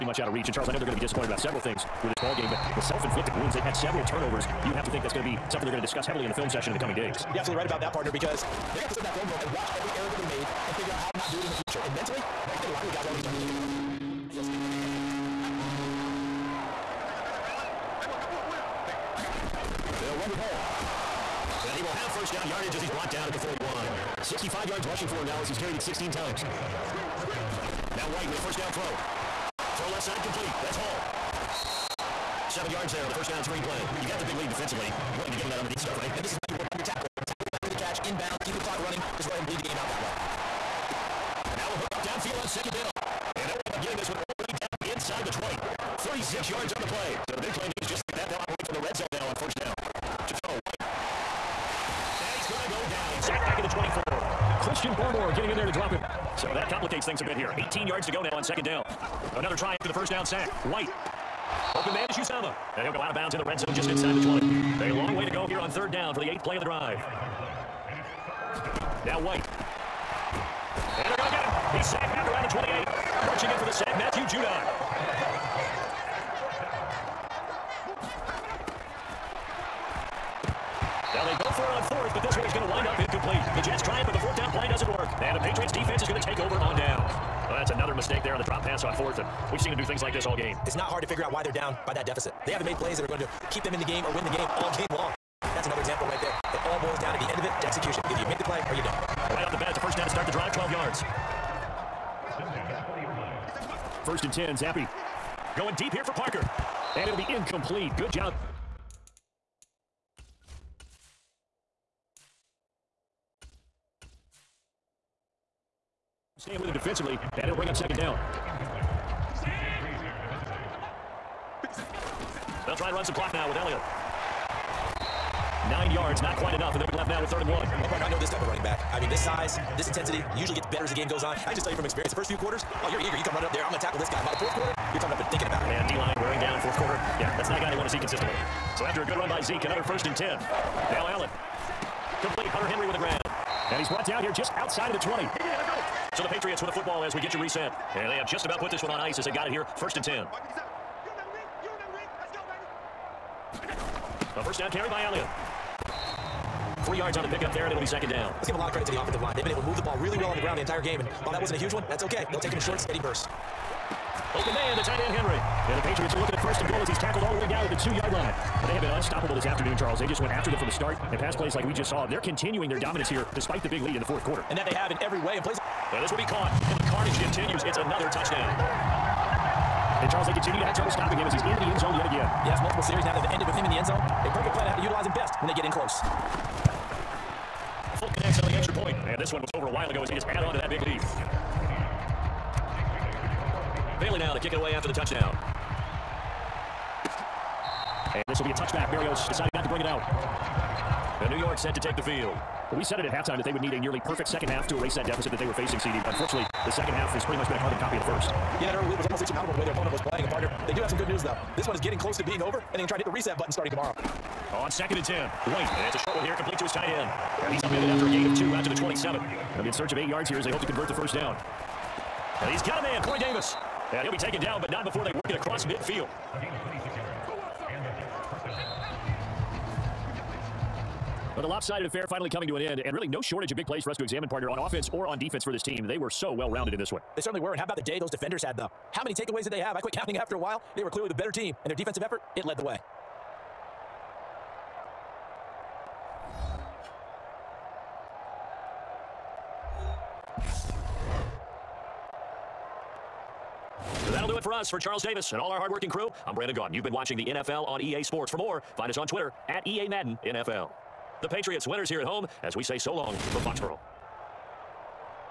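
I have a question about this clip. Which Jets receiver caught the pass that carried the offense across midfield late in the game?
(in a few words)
Corey Davis.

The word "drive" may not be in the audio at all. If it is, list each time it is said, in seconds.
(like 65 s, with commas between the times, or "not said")
66 s, 100 s.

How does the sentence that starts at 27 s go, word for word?
Now White with a first down throw.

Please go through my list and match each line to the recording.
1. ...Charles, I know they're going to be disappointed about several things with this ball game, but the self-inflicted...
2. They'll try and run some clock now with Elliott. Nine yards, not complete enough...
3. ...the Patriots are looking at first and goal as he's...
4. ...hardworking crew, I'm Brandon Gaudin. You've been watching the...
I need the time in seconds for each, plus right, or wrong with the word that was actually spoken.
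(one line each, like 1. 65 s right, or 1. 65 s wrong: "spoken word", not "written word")
1. 0 s right
2. 122 s wrong: "quite", not "complete"
3. 165 s right
4. 255 s right.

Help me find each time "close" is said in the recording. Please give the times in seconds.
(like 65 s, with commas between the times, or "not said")
185 s, 211 s.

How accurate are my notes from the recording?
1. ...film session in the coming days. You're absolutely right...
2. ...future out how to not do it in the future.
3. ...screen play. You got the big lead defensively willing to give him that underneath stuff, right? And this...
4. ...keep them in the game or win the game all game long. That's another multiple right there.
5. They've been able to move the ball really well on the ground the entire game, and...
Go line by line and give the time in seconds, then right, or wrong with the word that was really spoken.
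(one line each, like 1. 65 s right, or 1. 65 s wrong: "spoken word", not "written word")
1. 6 s right
2. 10 s wrong: "figure", not "future"
3. 33 s right
4. 93 s wrong: "example", not "multiple"
5. 159 s right.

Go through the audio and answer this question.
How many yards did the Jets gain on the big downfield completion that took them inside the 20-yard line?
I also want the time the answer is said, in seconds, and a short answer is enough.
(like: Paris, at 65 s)
36, at 45 s.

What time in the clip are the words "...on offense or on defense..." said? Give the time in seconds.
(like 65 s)
234 s.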